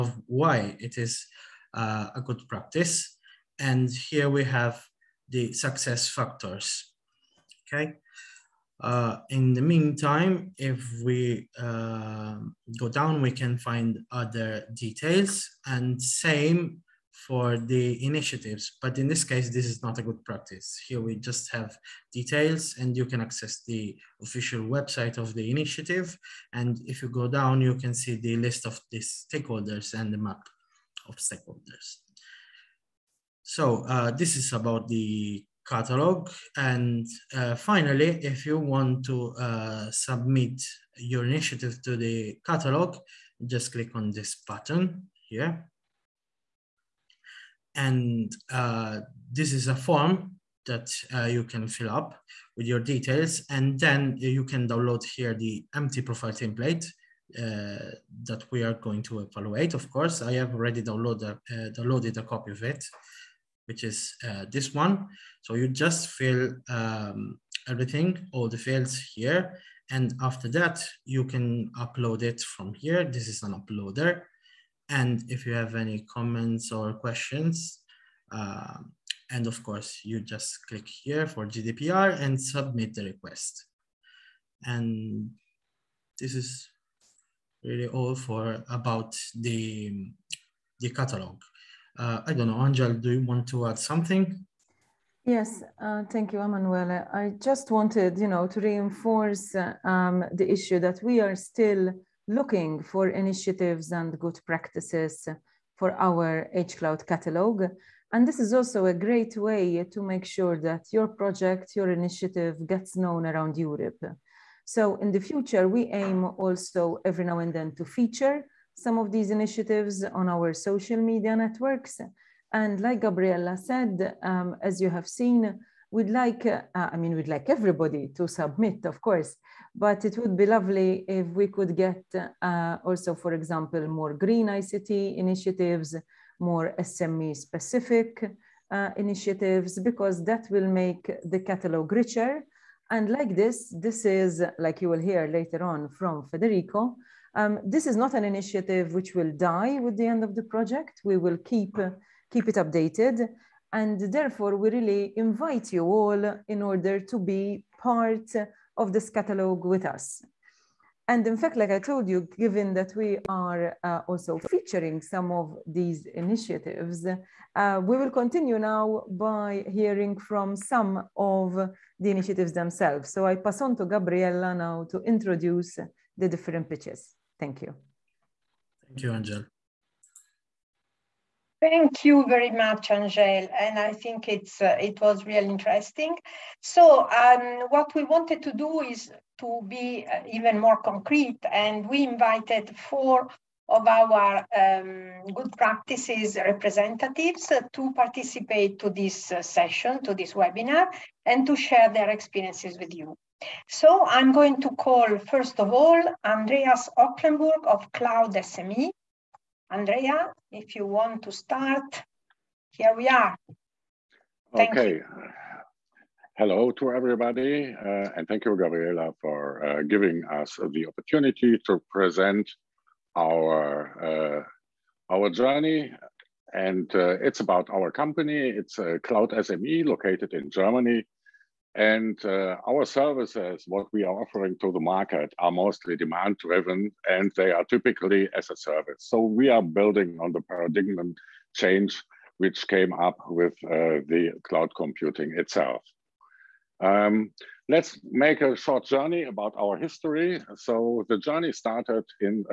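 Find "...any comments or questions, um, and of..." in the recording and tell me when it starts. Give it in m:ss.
1:15.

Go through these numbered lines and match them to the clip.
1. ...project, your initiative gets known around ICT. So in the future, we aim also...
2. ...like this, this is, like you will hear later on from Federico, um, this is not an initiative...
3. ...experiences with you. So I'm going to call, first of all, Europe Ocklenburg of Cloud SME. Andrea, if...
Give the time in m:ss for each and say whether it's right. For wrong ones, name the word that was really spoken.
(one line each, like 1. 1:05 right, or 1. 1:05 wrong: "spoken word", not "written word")
1. 1:51 wrong: "Europe", not "ICT"
2. 2:23 right
3. 3:22 wrong: "Andreas", not "Europe".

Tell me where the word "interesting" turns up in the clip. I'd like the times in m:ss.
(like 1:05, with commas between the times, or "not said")
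3:05.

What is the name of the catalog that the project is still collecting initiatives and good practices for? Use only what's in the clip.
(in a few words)
HCloud catalog.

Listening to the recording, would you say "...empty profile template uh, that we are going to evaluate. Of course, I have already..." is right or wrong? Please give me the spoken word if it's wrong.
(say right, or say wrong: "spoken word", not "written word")
right.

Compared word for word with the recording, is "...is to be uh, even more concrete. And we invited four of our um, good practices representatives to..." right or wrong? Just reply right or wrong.
right.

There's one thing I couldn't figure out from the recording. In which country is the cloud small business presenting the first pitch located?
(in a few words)
Germany.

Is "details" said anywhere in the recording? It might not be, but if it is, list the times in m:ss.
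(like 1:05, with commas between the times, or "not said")
0:14, 0:22, 0:52.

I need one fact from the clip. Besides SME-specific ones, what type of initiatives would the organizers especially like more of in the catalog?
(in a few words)
Green ICT.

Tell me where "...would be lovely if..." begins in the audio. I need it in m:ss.
2:10.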